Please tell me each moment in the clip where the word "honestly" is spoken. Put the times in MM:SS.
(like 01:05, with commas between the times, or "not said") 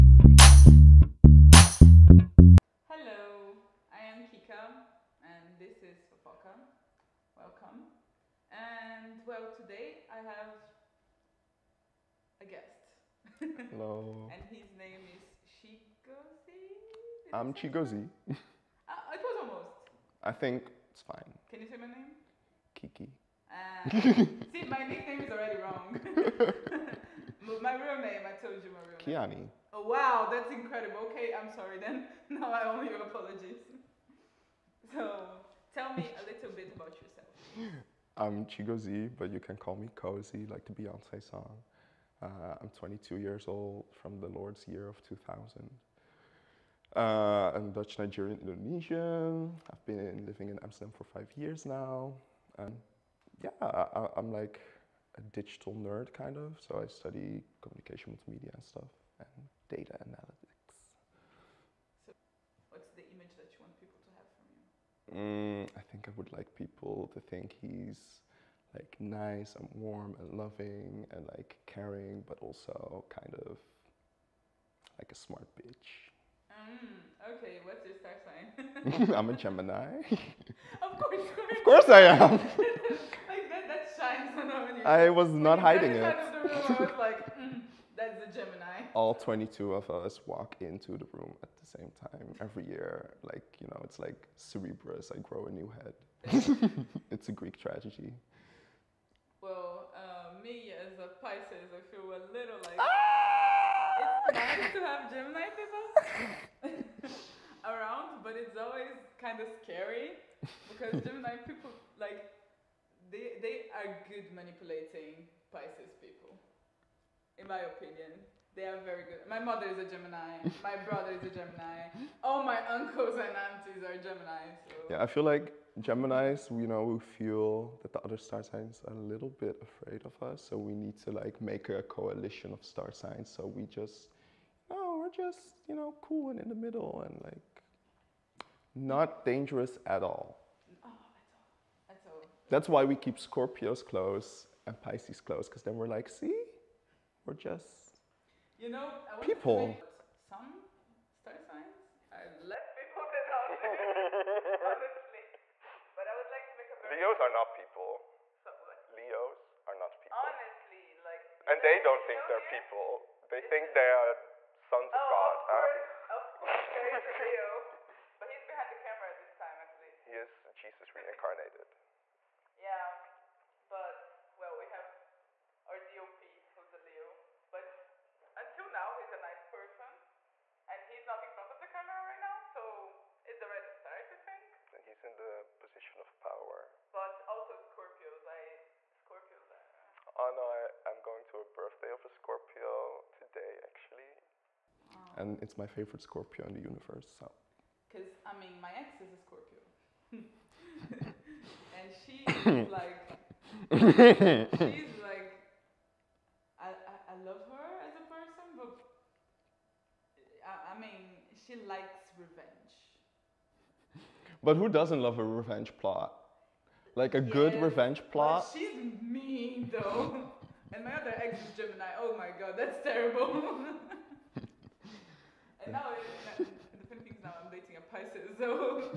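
02:34, 02:40.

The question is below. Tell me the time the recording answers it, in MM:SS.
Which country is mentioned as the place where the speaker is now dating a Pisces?
03:46.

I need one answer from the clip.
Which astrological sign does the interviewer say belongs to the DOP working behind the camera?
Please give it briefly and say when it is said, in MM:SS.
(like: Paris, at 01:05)
Leo, at 02:56.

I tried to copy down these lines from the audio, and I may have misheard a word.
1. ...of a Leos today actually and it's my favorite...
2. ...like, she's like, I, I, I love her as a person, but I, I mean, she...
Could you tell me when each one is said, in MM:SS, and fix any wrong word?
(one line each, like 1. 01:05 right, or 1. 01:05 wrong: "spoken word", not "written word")
1. 03:11 wrong: "Scorpio", not "Leos"
2. 03:22 right.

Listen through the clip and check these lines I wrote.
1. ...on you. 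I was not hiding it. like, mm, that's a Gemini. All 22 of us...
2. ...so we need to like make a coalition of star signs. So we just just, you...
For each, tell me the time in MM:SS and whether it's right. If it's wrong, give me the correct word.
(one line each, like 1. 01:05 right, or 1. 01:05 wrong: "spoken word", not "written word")
1. 01:24 right
2. 02:10 right.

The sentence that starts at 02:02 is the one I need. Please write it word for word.
All my uncles and aunties are Gemini.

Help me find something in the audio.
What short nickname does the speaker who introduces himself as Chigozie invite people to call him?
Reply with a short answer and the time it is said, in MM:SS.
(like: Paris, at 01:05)
Cozy, at 00:39.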